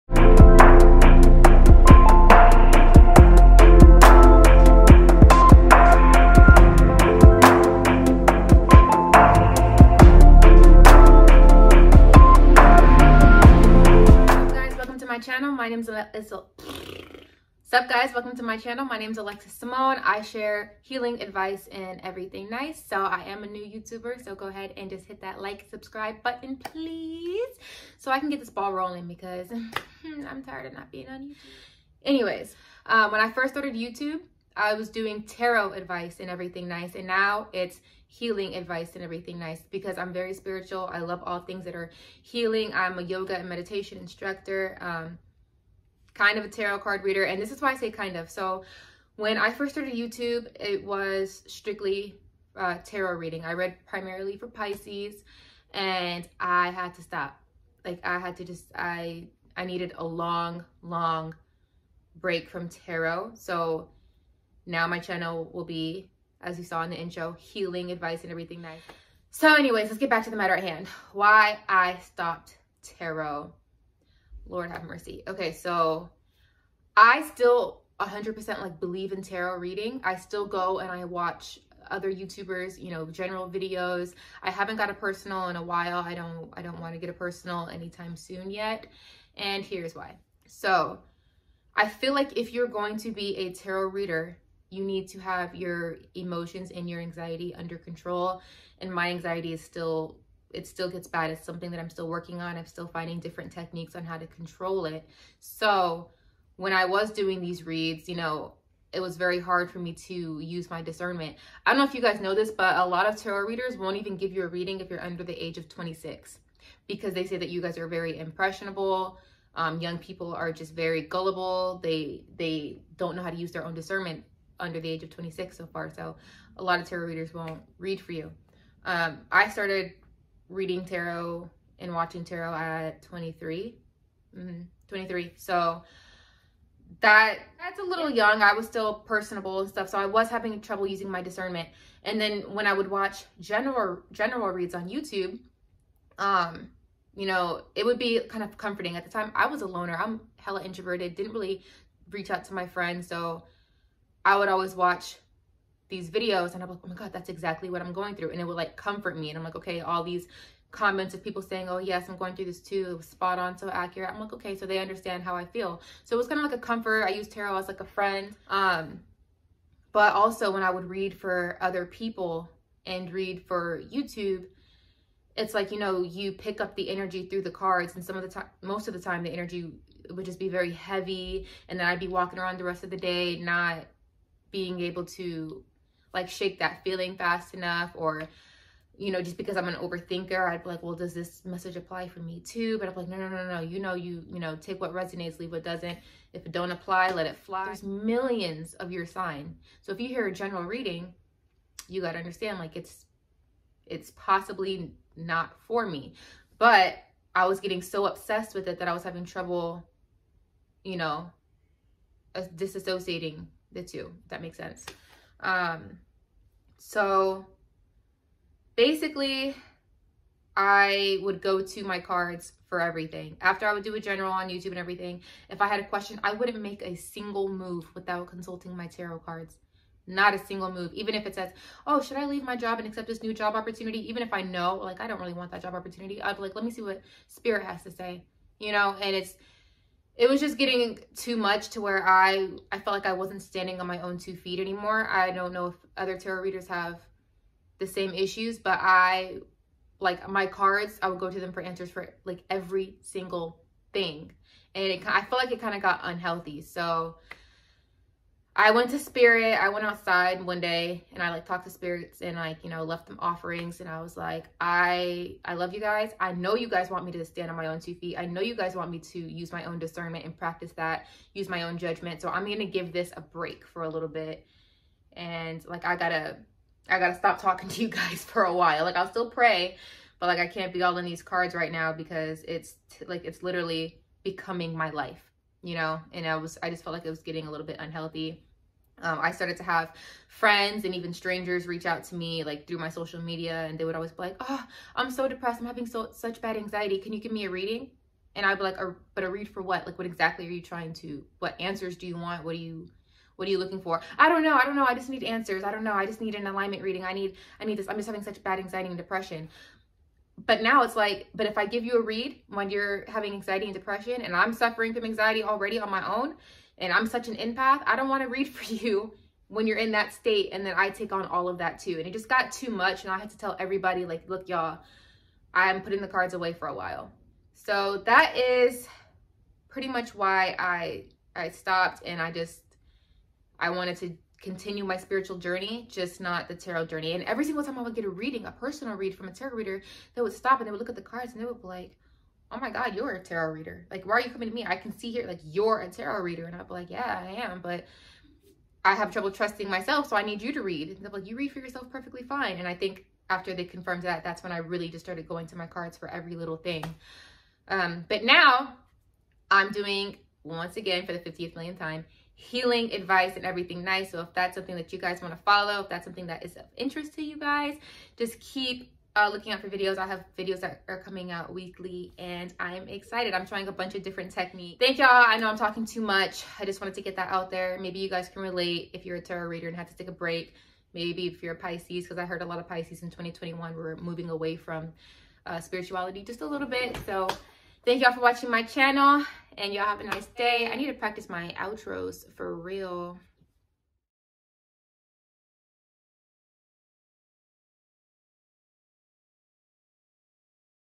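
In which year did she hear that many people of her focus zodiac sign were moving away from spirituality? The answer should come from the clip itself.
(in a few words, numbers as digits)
2021.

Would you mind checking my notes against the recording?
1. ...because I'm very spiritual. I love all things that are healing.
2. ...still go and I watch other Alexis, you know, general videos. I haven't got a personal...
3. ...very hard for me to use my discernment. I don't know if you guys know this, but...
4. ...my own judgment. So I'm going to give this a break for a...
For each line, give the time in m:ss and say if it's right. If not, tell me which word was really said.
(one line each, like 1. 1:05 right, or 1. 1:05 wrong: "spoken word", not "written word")
1. 0:39 right
2. 1:20 wrong: "YouTubers", not "Alexis"
3. 1:49 right
4. 4:31 right.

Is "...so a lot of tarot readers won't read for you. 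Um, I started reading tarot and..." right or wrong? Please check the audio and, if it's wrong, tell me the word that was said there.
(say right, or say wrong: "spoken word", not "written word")
right.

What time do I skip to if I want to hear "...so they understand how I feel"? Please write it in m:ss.
2:44.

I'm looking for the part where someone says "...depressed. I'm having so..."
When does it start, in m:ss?
4:55.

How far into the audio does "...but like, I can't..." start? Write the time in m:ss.
4:40.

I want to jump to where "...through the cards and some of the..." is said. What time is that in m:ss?
2:57.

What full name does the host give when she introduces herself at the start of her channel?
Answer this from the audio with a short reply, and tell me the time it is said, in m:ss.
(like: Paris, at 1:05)
Alexis Symone, at 0:19.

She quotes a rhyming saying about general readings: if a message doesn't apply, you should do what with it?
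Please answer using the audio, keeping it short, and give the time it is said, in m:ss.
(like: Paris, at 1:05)
Let it fly, at 3:17.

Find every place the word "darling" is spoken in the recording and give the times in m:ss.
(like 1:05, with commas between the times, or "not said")
not said.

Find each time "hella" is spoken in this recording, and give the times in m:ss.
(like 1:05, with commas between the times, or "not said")
2:30.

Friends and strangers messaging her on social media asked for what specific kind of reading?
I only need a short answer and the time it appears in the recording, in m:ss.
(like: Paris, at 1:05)
Alignment reading, at 5:06.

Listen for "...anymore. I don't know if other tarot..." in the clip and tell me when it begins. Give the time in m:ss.
4:04.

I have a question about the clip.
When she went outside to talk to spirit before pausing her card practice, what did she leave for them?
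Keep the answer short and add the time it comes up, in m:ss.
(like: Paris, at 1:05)
Offerings, at 4:23.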